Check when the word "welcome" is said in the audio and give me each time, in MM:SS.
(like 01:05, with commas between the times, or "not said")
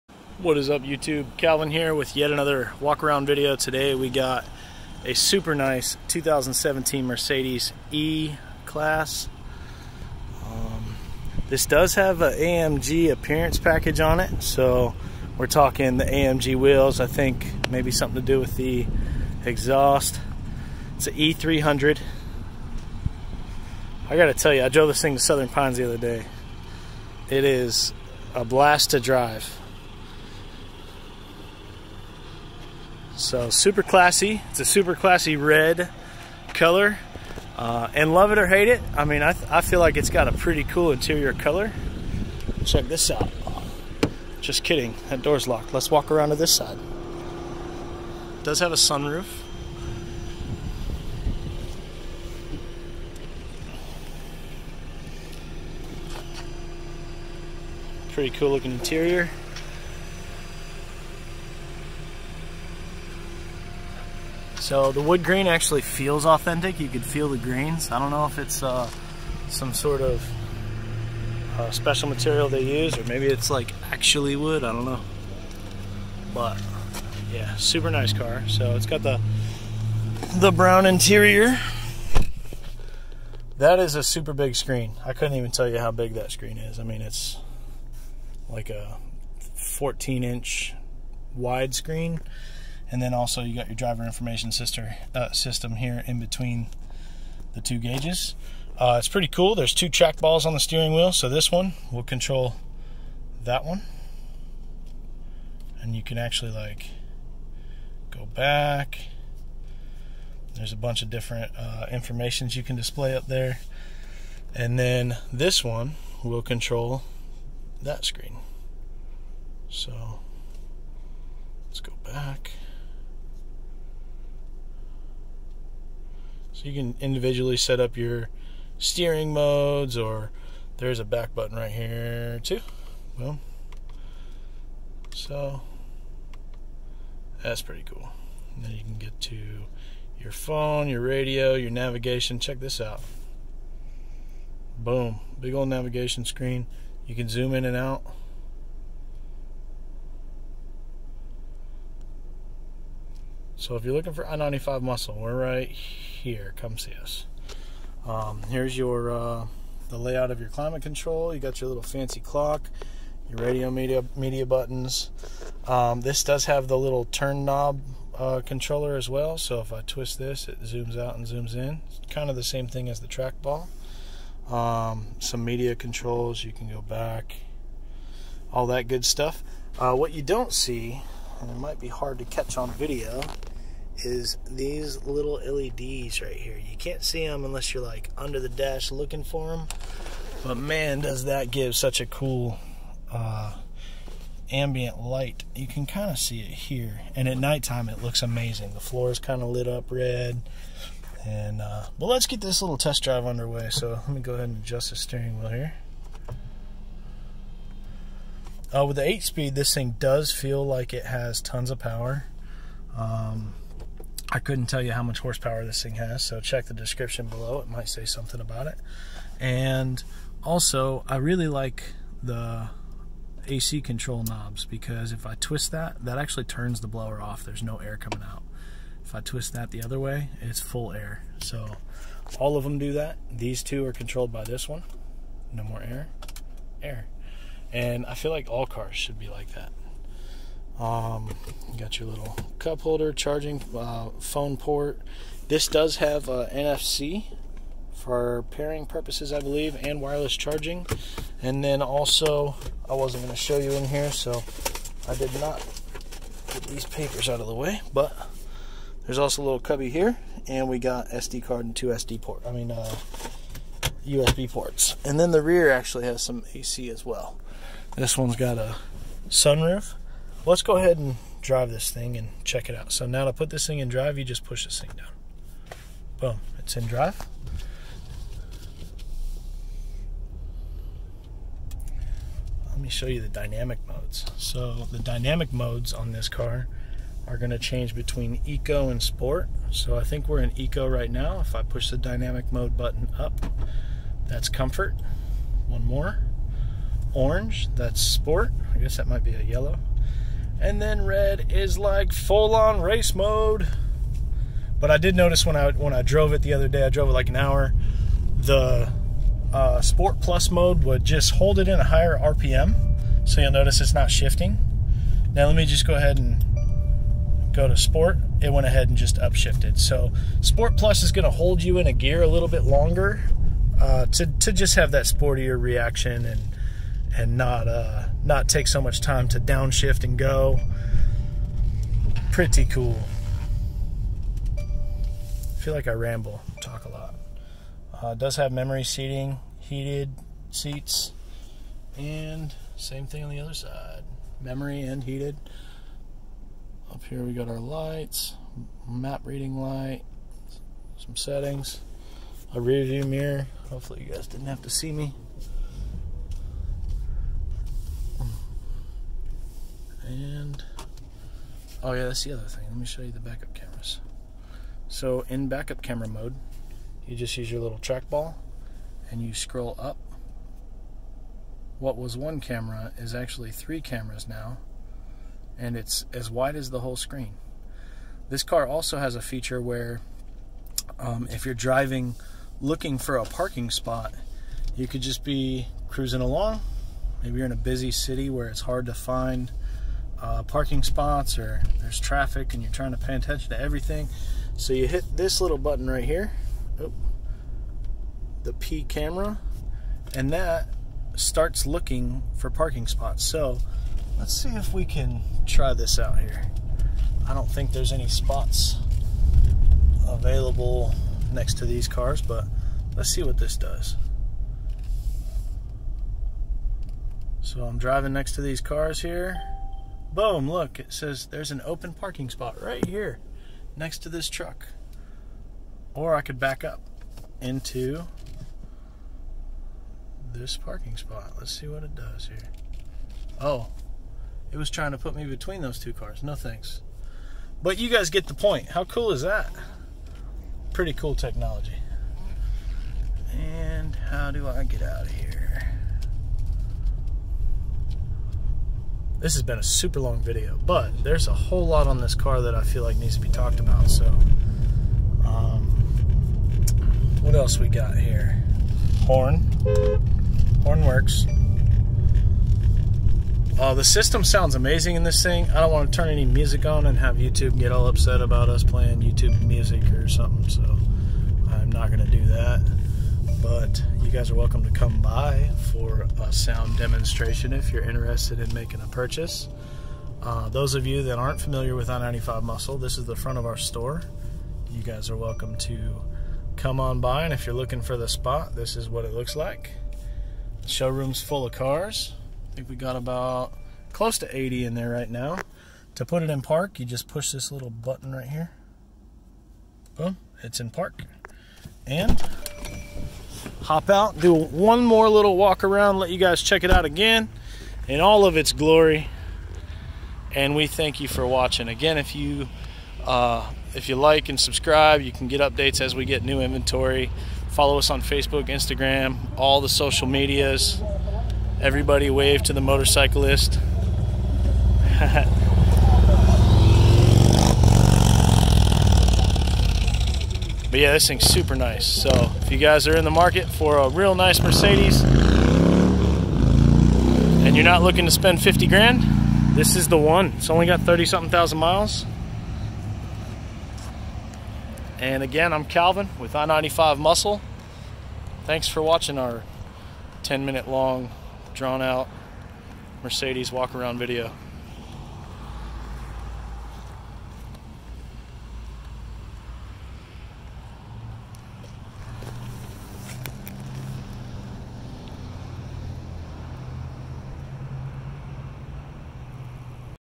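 07:54, 08:05.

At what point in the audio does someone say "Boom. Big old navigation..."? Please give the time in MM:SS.
02:24.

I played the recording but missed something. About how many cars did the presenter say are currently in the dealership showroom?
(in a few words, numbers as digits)
80.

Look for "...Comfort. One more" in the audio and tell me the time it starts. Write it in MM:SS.
04:54.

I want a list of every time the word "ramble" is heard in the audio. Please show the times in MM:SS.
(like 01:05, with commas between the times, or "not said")
05:35.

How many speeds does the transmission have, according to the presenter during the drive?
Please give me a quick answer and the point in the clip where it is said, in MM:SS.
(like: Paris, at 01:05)
8, at 03:29.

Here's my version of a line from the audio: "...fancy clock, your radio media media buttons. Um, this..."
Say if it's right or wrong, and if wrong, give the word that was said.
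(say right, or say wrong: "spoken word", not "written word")
right.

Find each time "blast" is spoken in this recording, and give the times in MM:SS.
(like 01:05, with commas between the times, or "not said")
00:28.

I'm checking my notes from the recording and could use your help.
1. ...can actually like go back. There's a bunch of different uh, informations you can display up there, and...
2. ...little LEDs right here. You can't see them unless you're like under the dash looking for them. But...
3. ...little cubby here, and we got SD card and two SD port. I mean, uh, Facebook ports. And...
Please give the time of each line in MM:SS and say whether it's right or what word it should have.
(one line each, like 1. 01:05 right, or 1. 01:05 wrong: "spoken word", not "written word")
1. 01:46 right
2. 03:05 right
3. 04:19 wrong: "USB", not "Facebook".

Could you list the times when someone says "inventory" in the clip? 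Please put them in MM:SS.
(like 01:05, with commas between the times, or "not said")
08:36.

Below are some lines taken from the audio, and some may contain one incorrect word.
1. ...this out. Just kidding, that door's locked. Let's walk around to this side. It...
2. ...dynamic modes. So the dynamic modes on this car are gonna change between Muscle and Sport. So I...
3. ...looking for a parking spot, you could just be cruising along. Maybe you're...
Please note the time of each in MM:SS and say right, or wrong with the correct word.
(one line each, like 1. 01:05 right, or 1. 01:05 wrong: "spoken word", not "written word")
1. 00:42 right
2. 04:43 wrong: "Eco", not "Muscle"
3. 06:22 right.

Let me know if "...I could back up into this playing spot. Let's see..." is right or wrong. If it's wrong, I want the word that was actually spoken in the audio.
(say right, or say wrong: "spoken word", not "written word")
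wrong: "parking", not "playing".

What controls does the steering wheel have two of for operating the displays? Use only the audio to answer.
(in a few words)
track balls.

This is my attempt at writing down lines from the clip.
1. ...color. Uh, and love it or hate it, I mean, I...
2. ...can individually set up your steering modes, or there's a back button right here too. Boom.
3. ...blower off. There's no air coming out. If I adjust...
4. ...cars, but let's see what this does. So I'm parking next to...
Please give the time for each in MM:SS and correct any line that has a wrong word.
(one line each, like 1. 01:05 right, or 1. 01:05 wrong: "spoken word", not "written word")
1. 00:36 right
2. 02:06 right
3. 03:46 wrong: "twist", not "adjust"
4. 06:51 wrong: "driving", not "parking".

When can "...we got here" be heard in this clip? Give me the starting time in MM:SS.
07:37.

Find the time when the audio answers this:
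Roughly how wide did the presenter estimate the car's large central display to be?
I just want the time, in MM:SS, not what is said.
01:29.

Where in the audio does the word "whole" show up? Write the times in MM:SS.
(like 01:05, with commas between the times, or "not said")
06:16, 07:31.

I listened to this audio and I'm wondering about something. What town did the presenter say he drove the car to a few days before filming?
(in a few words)
Southern Pines.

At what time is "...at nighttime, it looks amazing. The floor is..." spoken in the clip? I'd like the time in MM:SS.
03:17.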